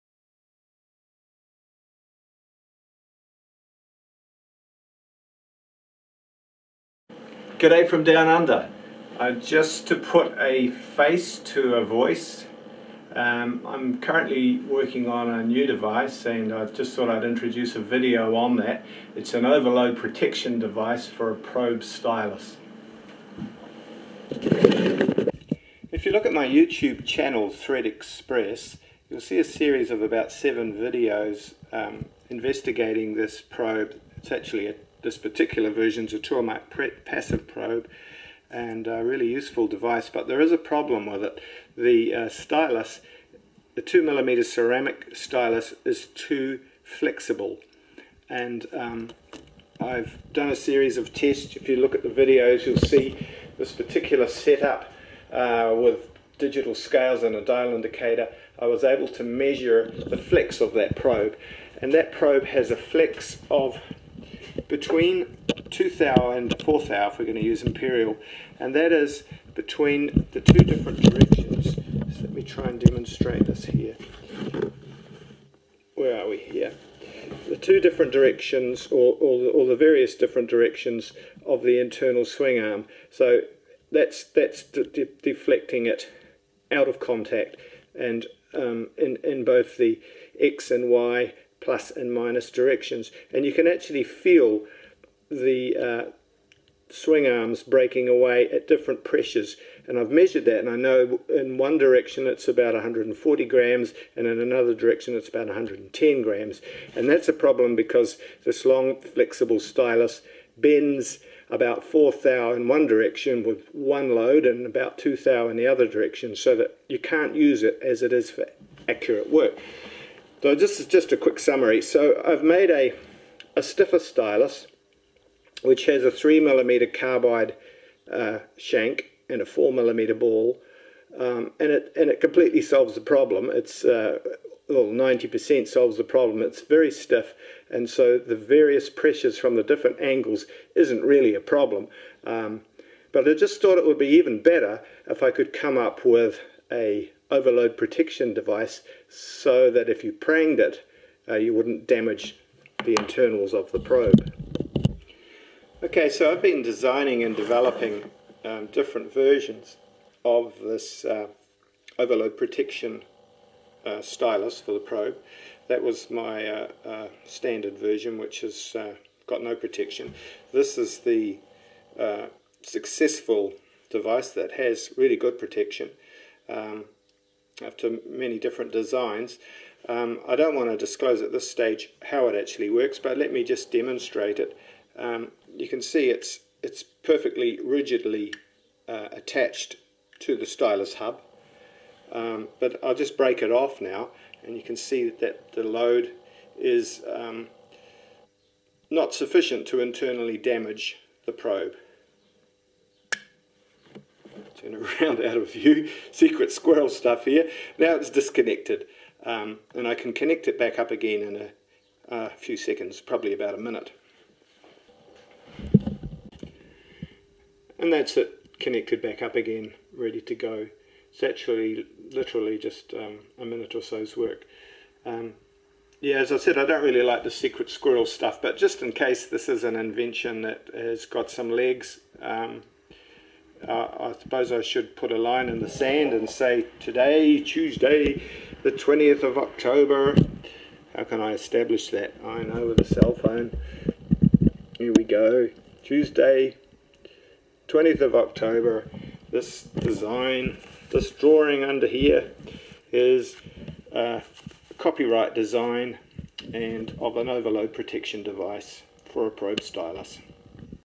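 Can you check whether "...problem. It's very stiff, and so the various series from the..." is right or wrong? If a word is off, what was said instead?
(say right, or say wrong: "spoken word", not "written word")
wrong: "pressures", not "series".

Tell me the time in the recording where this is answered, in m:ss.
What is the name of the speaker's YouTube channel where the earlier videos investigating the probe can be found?
0:27.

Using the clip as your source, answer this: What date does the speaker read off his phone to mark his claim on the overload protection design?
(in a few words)
Tuesday, 20th of October.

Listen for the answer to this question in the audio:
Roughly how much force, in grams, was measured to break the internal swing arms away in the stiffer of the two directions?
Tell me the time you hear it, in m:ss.
1:42.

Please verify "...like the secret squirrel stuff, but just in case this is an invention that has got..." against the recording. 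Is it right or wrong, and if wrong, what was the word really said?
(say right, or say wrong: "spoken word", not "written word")
right.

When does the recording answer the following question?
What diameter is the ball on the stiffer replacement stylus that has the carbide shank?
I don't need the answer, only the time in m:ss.
2:09.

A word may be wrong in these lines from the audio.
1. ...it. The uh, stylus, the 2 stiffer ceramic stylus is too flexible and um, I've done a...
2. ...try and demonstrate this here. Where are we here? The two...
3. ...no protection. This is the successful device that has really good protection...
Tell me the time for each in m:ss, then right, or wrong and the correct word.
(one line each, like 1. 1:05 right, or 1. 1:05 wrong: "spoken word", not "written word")
1. 0:41 wrong: "millimeter", not "stiffer"
2. 1:12 right
3. 2:49 right.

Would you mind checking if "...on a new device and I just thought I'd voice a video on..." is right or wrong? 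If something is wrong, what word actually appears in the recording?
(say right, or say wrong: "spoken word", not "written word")
wrong: "introduce", not "voice".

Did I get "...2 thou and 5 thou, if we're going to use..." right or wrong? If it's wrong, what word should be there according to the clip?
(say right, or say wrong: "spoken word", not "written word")
wrong: "4", not "5".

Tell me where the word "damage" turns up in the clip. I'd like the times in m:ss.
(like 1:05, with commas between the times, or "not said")
2:31, 3:20.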